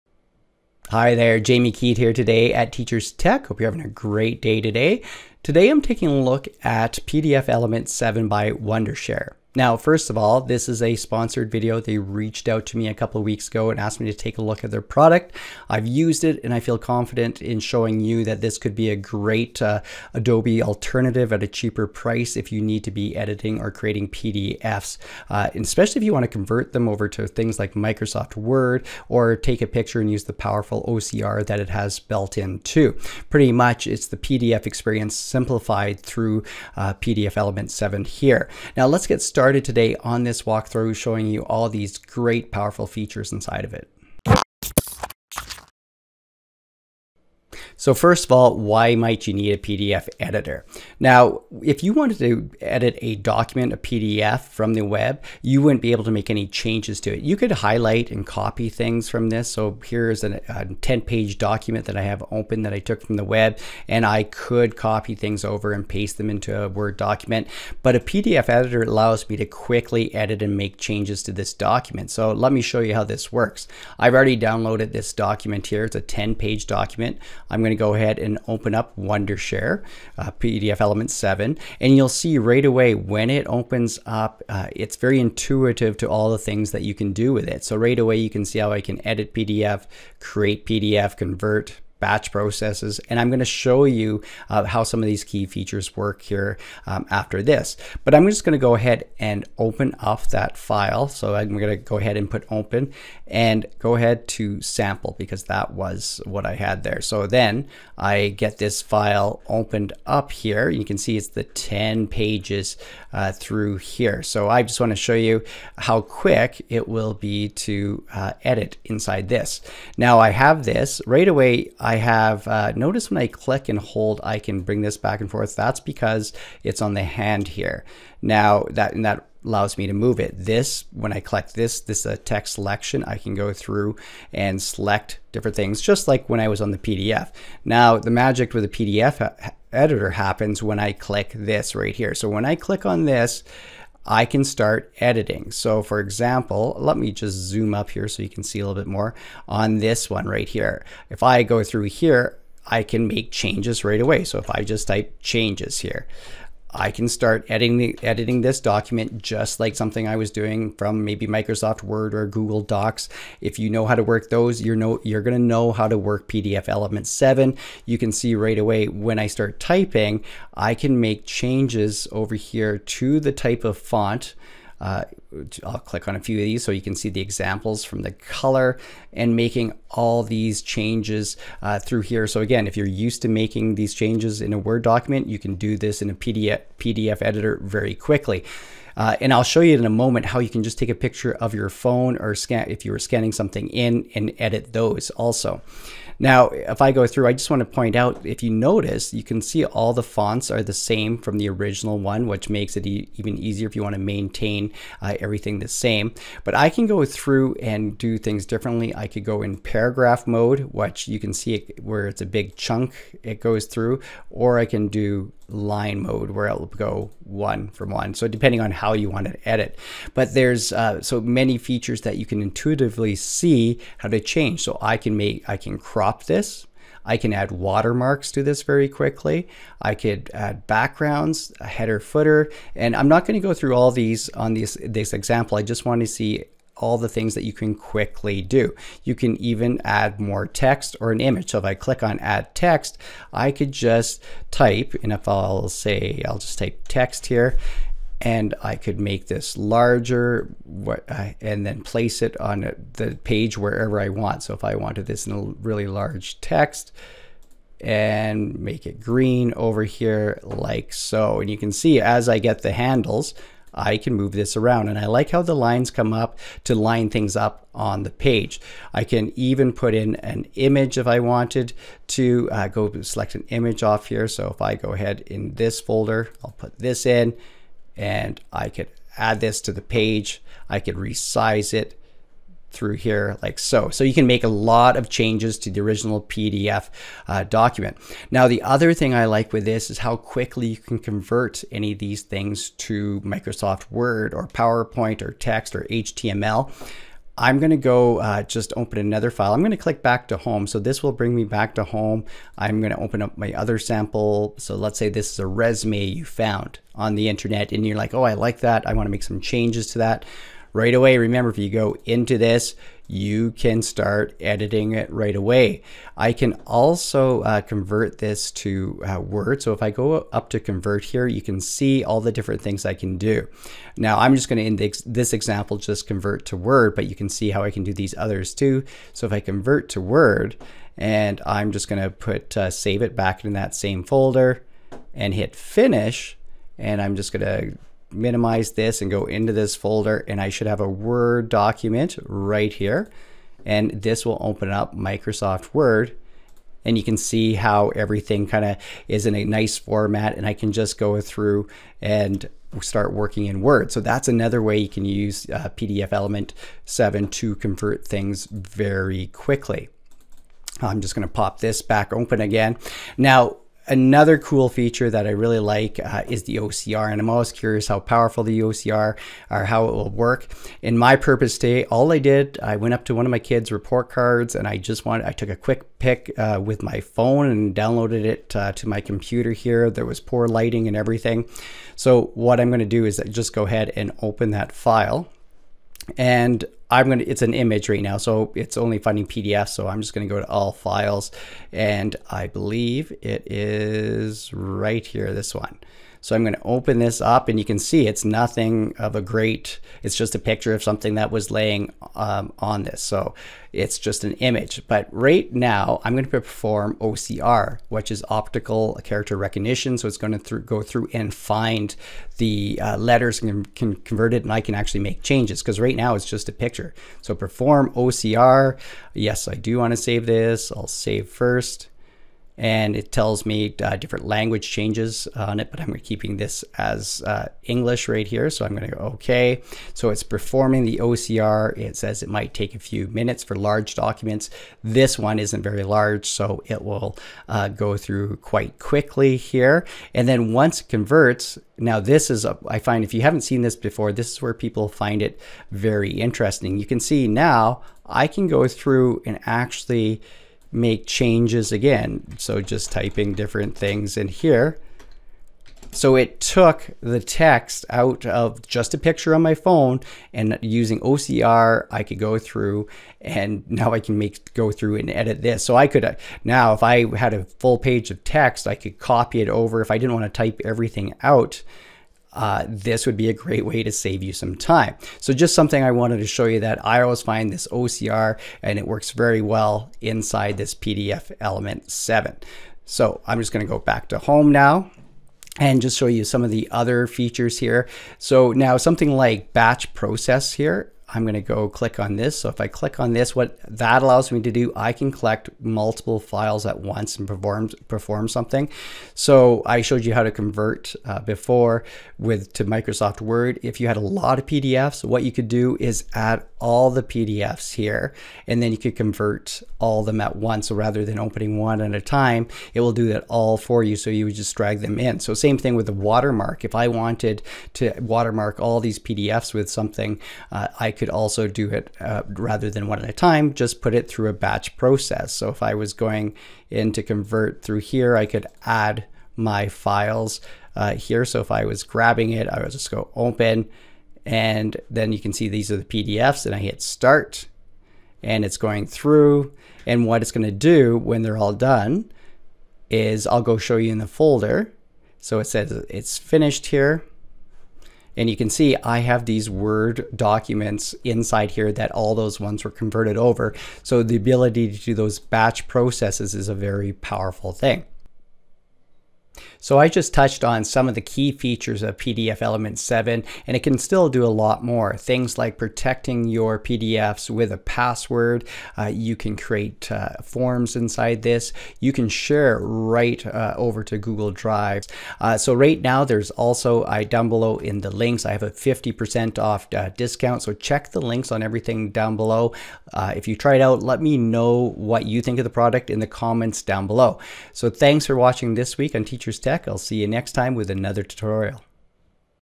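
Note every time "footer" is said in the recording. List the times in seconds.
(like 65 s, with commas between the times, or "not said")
231 s.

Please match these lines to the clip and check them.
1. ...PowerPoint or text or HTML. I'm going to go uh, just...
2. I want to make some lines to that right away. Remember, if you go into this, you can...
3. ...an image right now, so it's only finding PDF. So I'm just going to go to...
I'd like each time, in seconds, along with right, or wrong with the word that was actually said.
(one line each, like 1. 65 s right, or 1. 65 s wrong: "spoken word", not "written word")
1. 294 s right
2. 308 s wrong: "changes", not "lines"
3. 387 s right.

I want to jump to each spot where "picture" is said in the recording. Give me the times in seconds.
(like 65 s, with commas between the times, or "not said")
29 s, 190 s, 400 s, 416 s, 458 s.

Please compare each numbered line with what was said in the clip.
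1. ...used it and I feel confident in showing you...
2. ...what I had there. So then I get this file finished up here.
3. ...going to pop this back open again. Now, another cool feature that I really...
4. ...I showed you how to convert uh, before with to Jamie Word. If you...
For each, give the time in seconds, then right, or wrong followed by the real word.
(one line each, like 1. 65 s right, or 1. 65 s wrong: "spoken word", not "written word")
1. 15 s right
2. 106 s wrong: "opened", not "finished"
3. 361 s right
4. 499 s wrong: "Microsoft", not "Jamie".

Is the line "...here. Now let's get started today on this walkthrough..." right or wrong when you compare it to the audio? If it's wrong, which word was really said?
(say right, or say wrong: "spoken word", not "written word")
right.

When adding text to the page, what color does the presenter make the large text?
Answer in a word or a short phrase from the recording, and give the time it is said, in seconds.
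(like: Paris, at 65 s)
green, at 259 s.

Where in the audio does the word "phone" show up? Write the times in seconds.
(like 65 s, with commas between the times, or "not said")
191 s, 377 s, 459 s.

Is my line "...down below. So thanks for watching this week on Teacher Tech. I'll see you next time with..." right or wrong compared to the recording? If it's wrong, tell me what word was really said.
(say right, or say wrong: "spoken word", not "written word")
right.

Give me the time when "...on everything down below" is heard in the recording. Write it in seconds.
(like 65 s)
581 s.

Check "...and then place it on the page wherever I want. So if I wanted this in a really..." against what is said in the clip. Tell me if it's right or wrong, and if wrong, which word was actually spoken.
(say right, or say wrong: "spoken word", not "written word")
right.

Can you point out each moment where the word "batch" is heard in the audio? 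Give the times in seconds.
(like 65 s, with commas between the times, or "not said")
92 s, 489 s, 524 s, 555 s.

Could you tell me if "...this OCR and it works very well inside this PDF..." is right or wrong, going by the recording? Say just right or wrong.
right.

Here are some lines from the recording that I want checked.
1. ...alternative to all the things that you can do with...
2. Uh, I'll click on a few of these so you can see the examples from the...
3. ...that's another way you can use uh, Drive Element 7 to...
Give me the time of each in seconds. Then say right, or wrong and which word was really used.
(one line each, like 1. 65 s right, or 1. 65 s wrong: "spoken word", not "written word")
1. 85 s wrong: "intuitive", not "alternative"
2. 174 s right
3. 353 s wrong: "PDF", not "Drive".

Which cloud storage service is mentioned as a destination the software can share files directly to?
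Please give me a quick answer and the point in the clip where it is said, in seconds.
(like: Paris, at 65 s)
Google Drive, at 573 s.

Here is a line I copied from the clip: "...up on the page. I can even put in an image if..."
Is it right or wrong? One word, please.
right.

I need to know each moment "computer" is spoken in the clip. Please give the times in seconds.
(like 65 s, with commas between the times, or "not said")
379 s.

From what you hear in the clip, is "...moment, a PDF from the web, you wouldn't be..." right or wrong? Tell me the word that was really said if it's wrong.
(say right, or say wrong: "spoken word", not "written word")
wrong: "document", not "moment".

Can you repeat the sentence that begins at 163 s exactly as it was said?
If you know how to work those, you're know you're gonna know how to work PDF Element 7.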